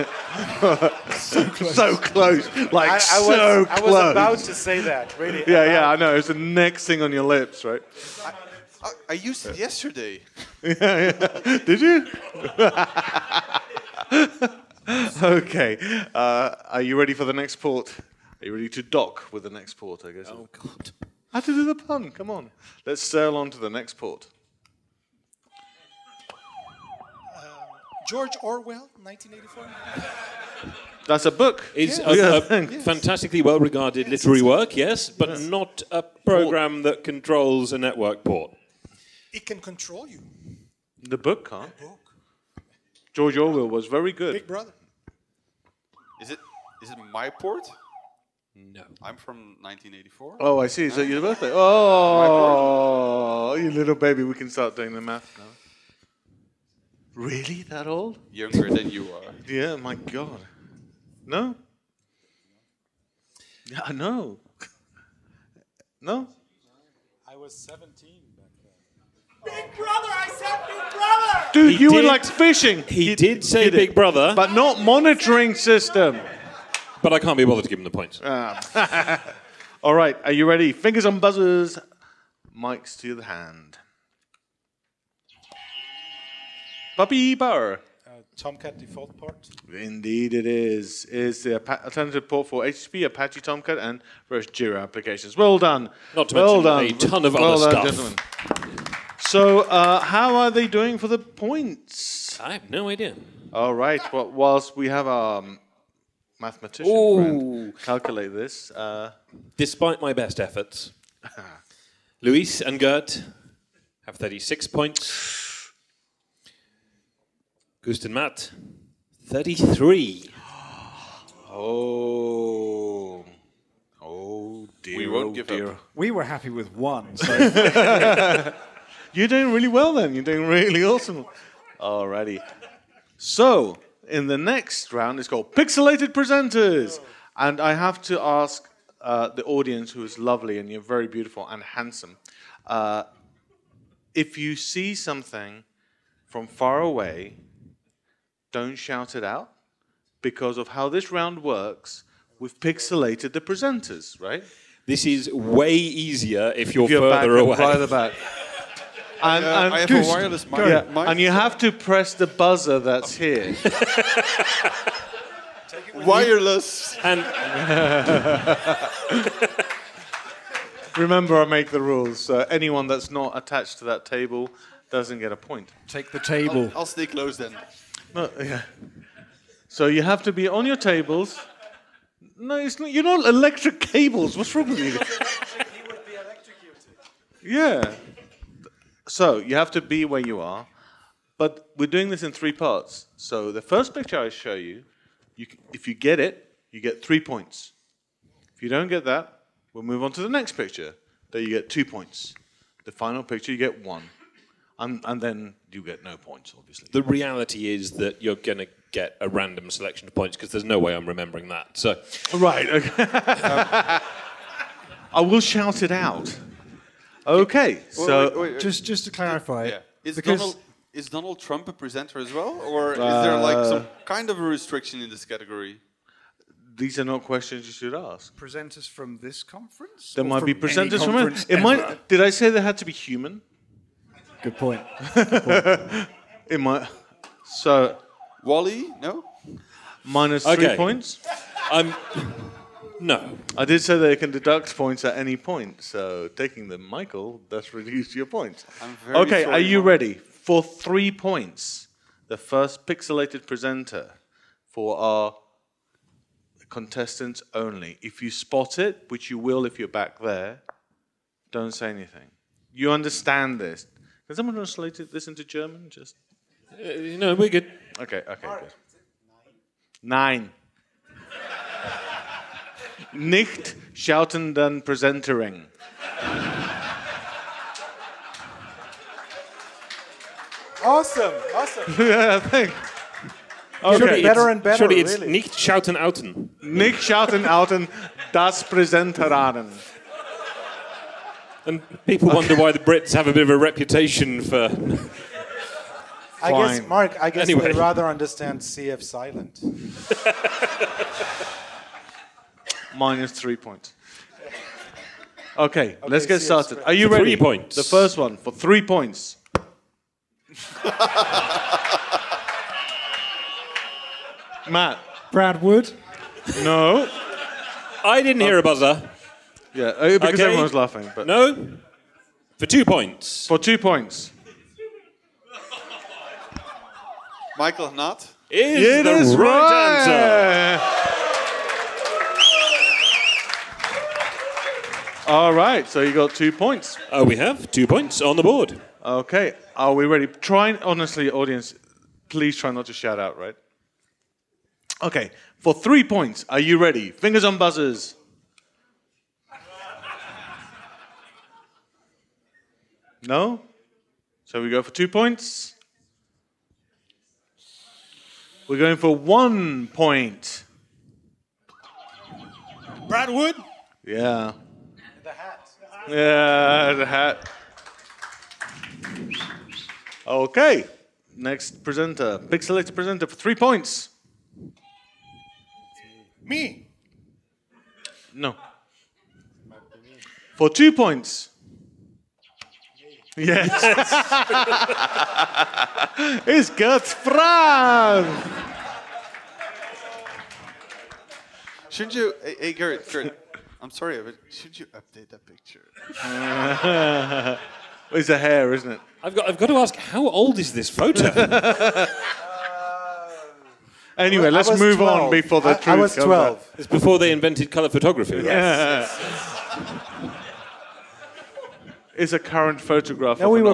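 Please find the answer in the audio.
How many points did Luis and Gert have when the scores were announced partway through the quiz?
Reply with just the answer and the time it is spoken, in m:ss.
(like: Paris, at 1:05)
36, at 1:54.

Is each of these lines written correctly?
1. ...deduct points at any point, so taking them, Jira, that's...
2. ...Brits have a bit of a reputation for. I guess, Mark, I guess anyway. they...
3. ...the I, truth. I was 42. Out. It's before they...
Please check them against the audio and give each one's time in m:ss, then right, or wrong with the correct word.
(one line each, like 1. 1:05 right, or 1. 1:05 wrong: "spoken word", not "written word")
1. 4:04 wrong: "Michael", not "Jira"
2. 4:52 right
3. 6:45 wrong: "12", not "42".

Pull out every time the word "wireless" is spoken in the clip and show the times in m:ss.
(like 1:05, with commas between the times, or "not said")
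2:40, 2:45.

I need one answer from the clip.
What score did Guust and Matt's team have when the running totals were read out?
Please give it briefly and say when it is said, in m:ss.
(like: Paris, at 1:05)
33, at 1:59.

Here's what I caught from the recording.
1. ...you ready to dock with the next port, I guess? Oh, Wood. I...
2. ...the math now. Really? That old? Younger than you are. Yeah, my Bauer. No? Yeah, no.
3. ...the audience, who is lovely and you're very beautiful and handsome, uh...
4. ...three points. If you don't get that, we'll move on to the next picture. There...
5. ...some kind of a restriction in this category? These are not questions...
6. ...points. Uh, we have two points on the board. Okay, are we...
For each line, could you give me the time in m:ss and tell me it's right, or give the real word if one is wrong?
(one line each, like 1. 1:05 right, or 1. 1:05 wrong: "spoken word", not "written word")
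1. 0:18 wrong: "God", not "Wood"
2. 0:54 wrong: "God", not "Bauer"
3. 2:19 right
4. 3:17 right
5. 3:43 right
6. 5:36 right.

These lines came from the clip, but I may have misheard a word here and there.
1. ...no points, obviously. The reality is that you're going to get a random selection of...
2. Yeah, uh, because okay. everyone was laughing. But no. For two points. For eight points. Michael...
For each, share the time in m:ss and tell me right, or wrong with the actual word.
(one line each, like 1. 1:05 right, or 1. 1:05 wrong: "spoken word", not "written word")
1. 3:26 right
2. 5:19 wrong: "two", not "eight".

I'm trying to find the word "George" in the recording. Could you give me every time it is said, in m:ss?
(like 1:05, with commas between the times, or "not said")
0:28, 0:43.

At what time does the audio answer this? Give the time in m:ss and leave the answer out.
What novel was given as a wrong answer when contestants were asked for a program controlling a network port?
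0:28.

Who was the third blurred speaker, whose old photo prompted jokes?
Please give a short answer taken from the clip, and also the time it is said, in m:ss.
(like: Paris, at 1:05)
Gert Franz, at 6:26.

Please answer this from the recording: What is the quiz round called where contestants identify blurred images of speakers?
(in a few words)
Pixelated Presenters.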